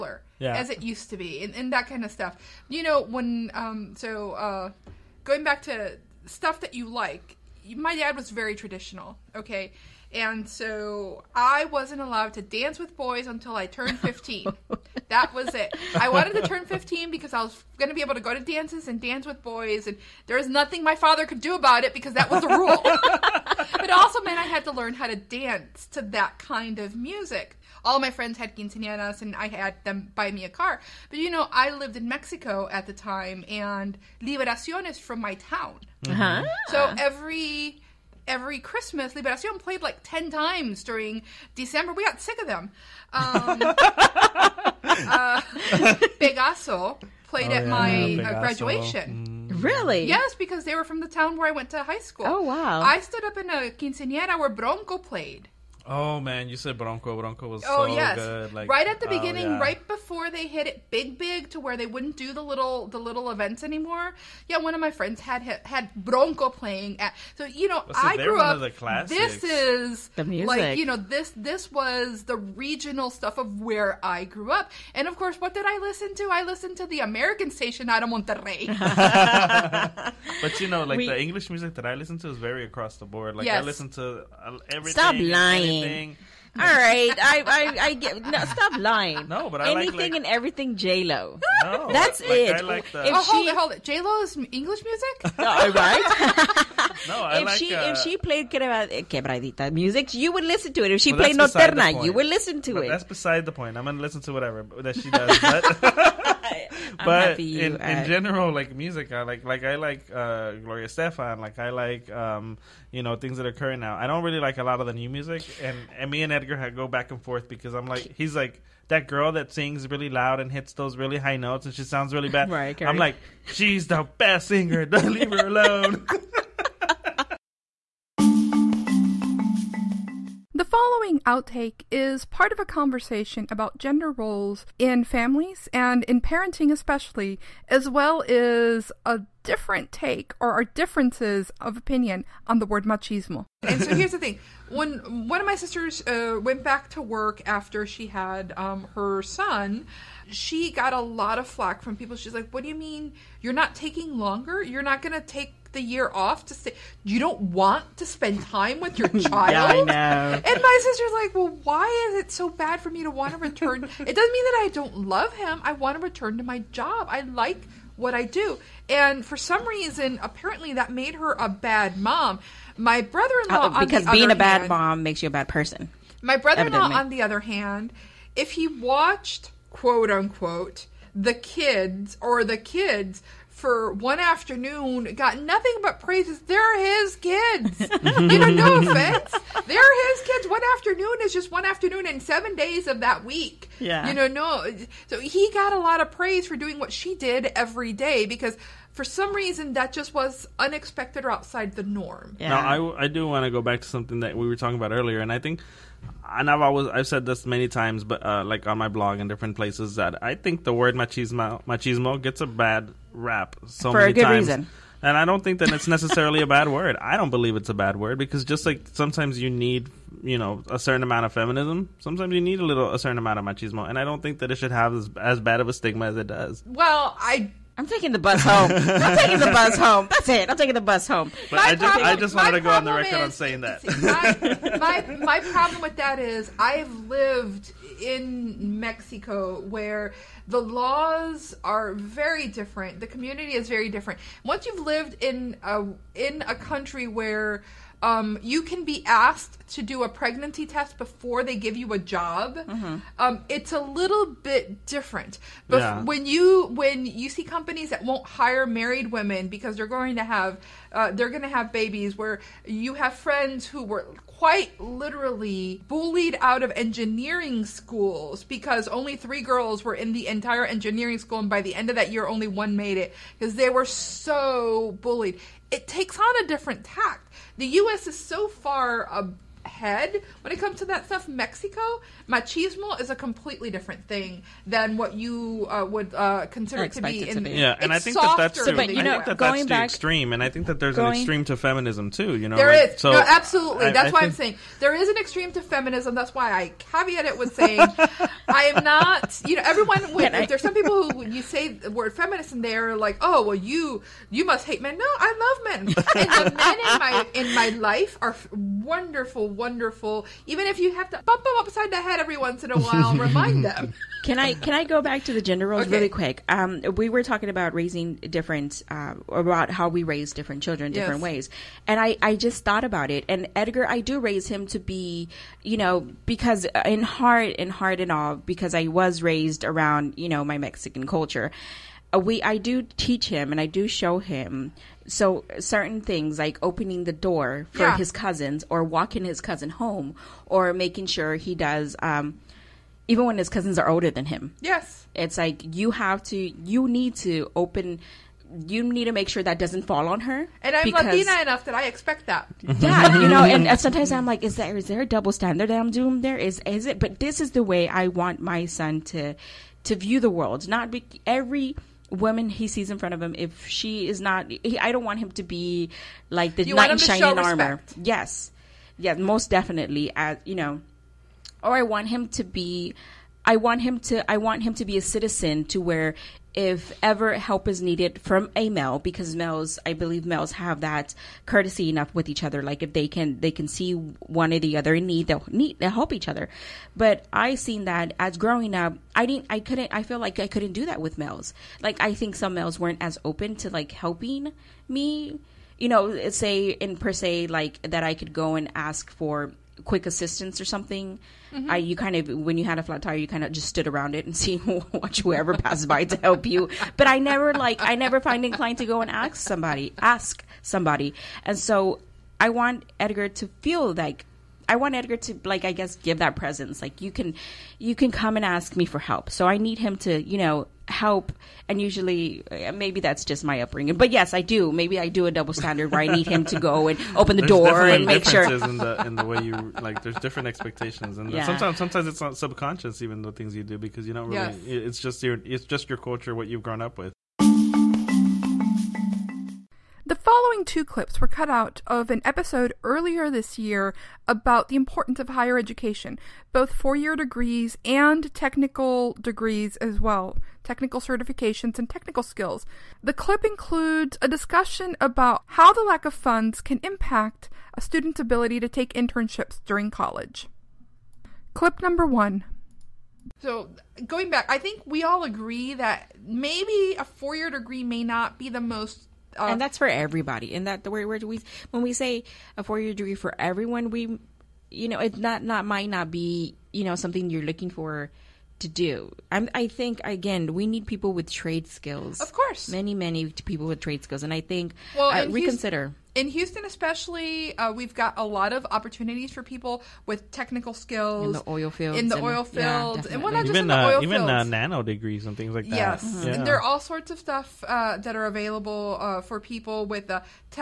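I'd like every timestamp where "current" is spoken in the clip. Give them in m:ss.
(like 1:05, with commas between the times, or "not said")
1:53.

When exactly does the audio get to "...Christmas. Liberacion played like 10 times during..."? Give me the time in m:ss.
0:38.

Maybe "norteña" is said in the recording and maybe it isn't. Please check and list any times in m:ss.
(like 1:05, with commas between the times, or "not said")
1:41.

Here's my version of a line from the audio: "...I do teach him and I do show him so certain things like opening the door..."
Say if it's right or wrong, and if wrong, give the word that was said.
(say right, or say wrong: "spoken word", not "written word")
right.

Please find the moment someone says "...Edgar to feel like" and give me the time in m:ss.
6:52.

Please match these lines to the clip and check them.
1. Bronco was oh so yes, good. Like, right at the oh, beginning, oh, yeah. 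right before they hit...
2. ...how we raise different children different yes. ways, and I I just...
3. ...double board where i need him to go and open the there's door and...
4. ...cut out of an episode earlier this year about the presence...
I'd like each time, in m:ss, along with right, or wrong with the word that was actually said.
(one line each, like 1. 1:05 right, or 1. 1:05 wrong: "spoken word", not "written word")
1. 0:57 right
2. 5:19 right
3. 7:05 wrong: "standard", not "board"
4. 7:21 wrong: "importance", not "presence".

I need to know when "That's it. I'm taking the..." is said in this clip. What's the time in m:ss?
3:50.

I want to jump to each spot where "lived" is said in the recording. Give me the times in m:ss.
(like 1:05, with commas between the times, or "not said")
0:31, 3:57, 4:04.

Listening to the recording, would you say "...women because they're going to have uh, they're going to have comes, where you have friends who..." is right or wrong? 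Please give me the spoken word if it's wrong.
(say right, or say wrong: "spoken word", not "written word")
wrong: "babies", not "comes".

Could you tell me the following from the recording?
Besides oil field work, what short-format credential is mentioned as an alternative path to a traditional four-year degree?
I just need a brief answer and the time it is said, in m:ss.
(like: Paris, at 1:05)
nano degrees, at 8:14.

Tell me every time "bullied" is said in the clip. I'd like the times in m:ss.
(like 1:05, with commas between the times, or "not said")
4:25, 4:34.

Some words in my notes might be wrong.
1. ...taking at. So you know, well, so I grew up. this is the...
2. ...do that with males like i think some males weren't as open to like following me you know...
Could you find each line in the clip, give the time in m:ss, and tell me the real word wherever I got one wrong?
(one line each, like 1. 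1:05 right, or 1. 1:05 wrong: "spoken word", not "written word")
1. 1:06 wrong: "playing", not "taking"
2. 6:30 wrong: "helping", not "following".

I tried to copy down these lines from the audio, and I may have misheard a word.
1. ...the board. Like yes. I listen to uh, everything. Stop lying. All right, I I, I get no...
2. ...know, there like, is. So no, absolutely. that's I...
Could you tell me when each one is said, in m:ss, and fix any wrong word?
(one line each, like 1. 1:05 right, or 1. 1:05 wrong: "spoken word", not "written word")
1. 1:22 right
2. 4:52 right.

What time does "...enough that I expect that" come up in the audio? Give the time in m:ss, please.
5:51.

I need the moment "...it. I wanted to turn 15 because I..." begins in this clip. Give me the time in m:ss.
0:15.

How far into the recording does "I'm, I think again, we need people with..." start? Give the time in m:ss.
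7:59.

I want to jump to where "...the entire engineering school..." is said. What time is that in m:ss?
4:30.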